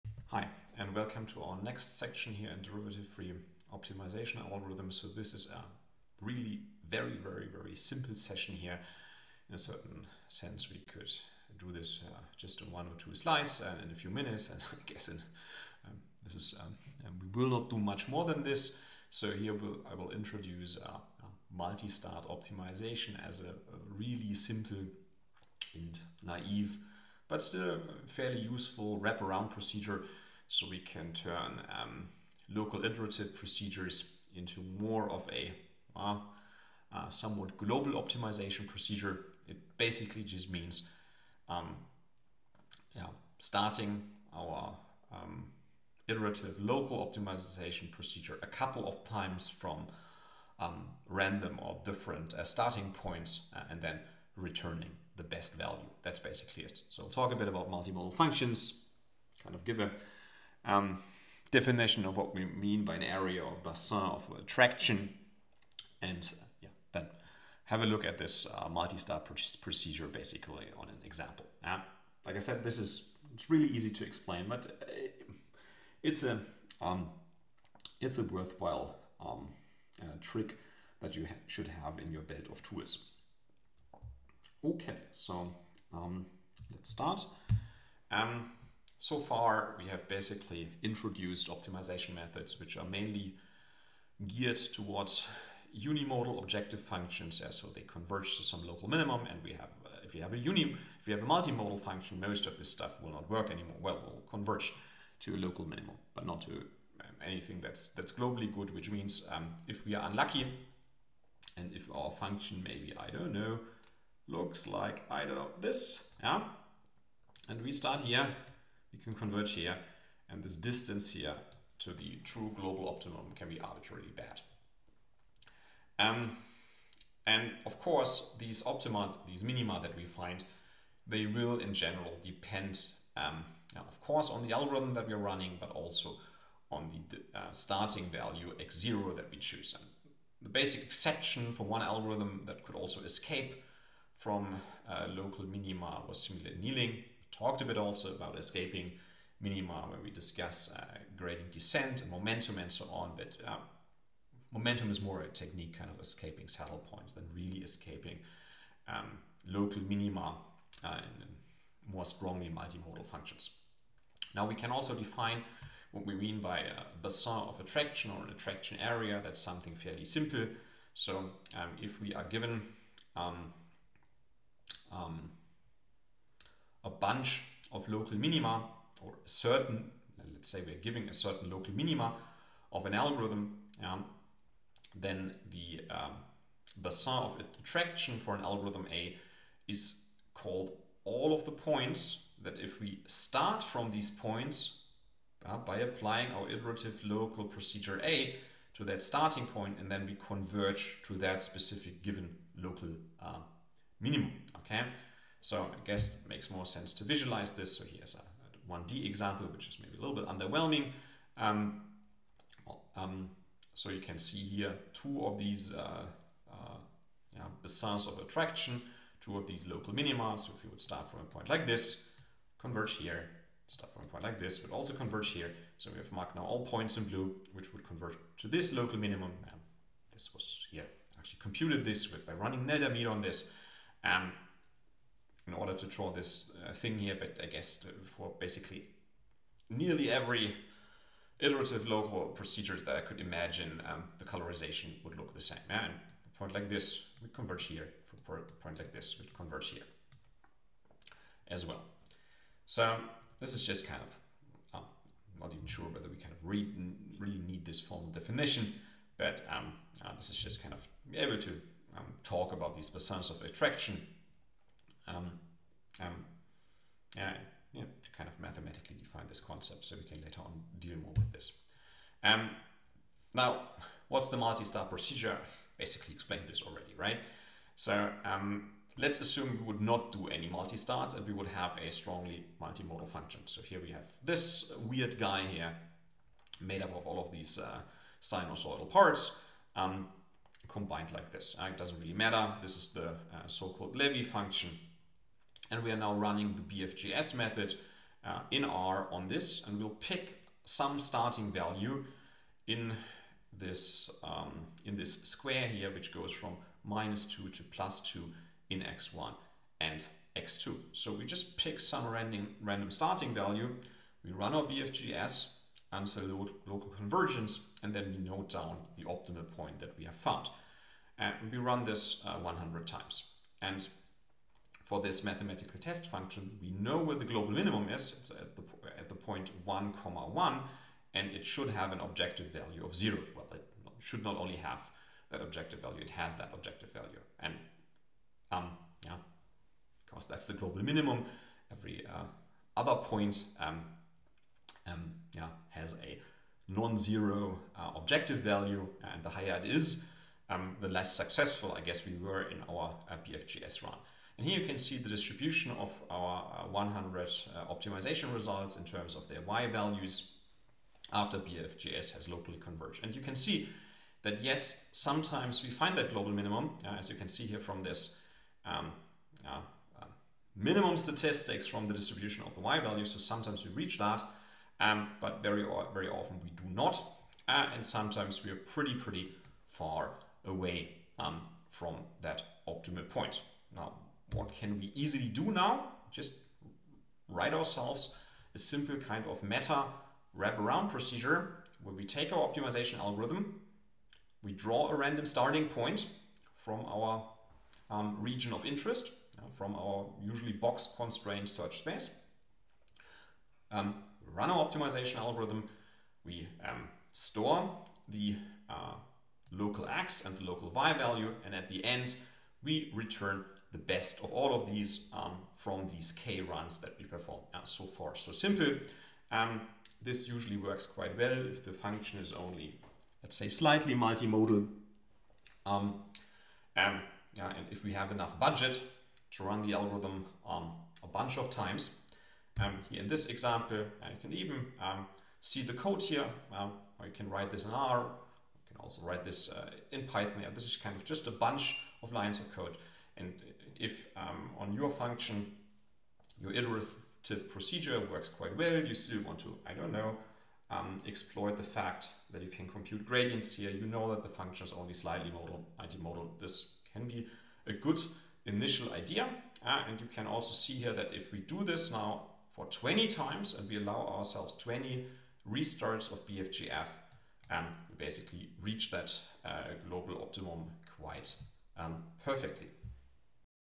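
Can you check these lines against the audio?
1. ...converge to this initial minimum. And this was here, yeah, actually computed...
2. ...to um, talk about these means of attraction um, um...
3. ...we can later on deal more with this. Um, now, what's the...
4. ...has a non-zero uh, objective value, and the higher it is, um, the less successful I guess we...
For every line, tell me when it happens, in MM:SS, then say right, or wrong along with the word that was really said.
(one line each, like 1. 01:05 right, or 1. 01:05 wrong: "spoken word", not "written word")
1. 03:47 wrong: "local", not "initial"
2. 04:21 wrong: "basins", not "means"
3. 04:29 right
4. 05:45 right.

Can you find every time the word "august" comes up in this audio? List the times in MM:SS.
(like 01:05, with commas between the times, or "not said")
not said.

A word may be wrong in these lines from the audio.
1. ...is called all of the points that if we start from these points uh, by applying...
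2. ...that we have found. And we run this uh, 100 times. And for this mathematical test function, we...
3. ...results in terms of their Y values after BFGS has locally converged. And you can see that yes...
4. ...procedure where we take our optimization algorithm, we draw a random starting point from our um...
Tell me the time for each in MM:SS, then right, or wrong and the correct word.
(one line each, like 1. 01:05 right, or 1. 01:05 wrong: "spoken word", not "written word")
1. 03:09 right
2. 05:19 right
3. 05:58 right
4. 06:30 right.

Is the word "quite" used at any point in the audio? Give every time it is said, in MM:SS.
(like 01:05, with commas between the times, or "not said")
07:00, 07:28, 07:50.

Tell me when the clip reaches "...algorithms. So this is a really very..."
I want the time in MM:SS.
00:04.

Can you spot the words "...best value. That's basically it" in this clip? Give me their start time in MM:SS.
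00:55.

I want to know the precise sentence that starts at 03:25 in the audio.
So I guess it makes more sense to visualize this.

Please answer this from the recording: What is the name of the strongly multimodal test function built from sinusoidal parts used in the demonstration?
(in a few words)
Levy function.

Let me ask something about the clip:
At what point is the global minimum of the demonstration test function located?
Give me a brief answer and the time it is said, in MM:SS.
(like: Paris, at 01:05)
(1, 1), at 05:29.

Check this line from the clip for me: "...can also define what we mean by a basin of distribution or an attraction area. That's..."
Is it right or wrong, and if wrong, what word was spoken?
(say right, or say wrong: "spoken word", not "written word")
wrong: "attraction", not "distribution".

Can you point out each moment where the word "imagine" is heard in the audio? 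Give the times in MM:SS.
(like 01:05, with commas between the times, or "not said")
04:03.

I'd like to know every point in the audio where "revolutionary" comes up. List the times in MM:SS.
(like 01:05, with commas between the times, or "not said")
not said.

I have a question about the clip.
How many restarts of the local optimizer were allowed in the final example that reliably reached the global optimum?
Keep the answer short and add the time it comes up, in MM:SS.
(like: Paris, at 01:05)
20, at 07:44.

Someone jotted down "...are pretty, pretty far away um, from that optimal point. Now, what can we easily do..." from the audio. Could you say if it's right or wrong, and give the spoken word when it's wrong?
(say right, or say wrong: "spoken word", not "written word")
right.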